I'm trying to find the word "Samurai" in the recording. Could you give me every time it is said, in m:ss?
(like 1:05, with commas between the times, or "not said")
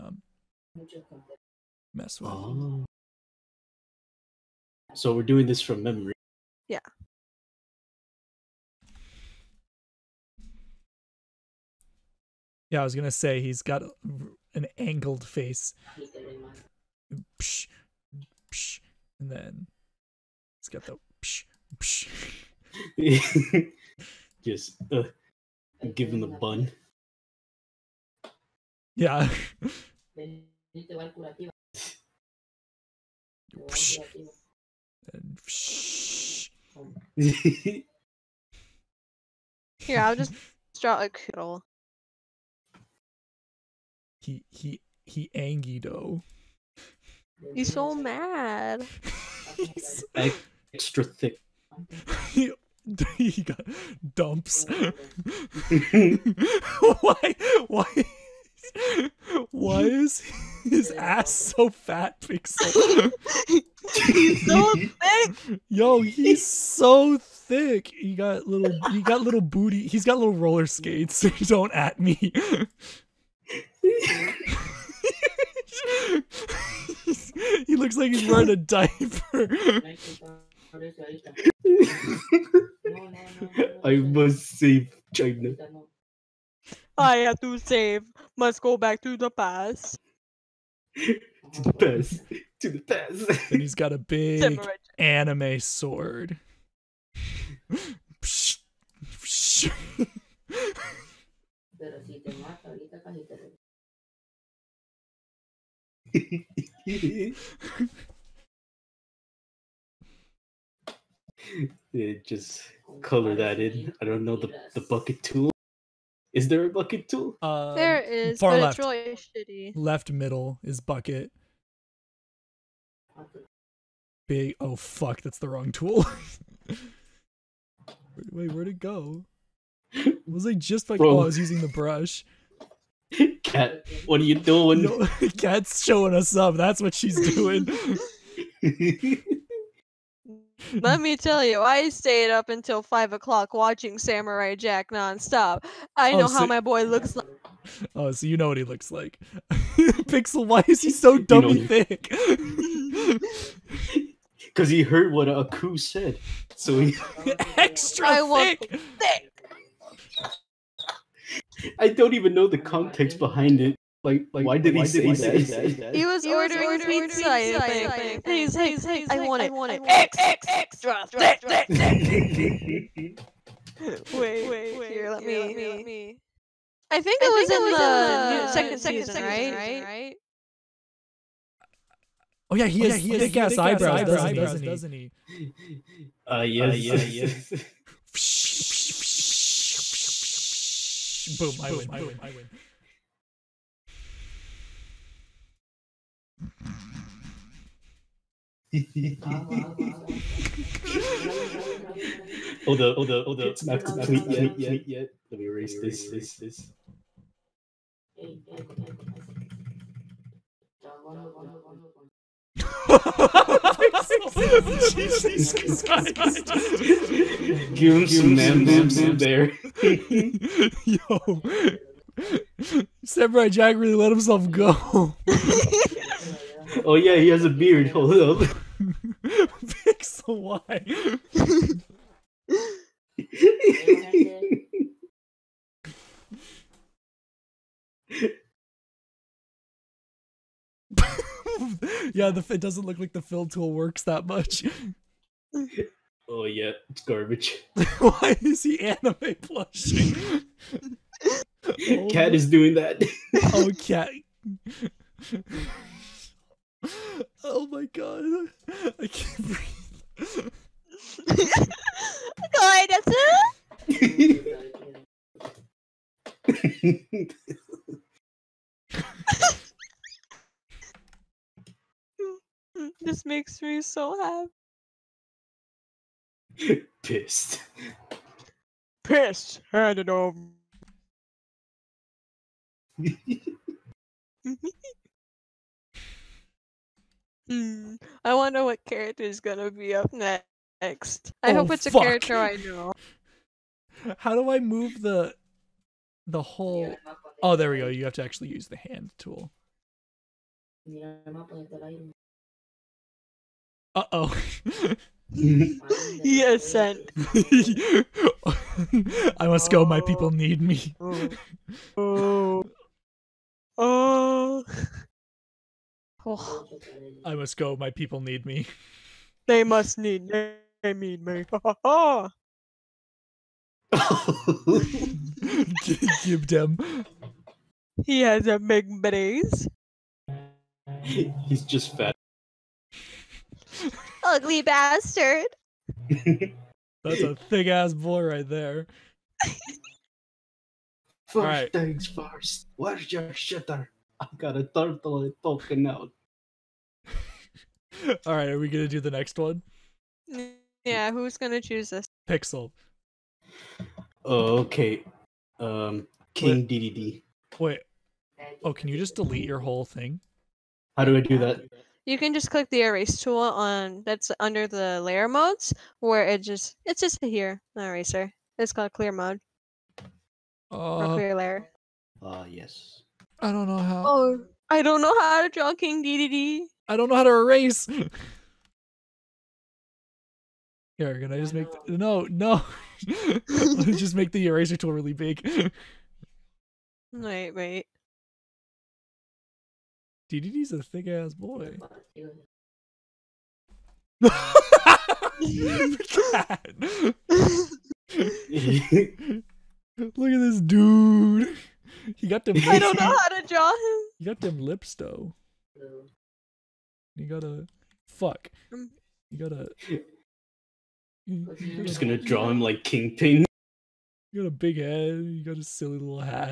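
2:23, 3:43.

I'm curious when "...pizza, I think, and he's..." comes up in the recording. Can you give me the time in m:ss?
2:46.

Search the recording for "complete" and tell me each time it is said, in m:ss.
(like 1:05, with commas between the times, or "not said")
3:23.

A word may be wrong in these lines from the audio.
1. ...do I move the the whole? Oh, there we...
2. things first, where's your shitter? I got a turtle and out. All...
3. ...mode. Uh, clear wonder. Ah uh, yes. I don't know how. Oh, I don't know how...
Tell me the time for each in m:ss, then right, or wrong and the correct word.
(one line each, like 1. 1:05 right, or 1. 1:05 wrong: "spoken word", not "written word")
1. 4:54 right
2. 5:41 right
3. 6:09 wrong: "layer", not "wonder".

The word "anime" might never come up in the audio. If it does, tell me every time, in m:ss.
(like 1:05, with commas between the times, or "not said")
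1:34, 4:08.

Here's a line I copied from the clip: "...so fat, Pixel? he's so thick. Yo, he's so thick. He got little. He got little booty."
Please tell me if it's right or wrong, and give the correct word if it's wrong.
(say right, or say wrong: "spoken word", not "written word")
right.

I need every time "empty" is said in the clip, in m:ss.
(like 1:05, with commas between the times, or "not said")
not said.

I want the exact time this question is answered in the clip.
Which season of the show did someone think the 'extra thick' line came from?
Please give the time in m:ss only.
2:58.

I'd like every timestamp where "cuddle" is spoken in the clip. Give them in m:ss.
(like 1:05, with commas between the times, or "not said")
0:41.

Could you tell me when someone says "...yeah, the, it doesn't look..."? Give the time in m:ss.
4:02.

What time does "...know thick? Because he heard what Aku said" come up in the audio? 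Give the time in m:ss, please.
2:31.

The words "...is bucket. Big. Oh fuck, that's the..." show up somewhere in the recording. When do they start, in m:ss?
2:00.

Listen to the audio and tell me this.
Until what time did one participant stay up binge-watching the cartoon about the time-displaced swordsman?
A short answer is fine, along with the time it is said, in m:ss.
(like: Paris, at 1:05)
5 o'clock, at 2:22.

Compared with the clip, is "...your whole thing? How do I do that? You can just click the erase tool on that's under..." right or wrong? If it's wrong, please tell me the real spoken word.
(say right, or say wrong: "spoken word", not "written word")
right.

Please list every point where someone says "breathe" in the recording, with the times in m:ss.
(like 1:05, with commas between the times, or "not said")
4:19.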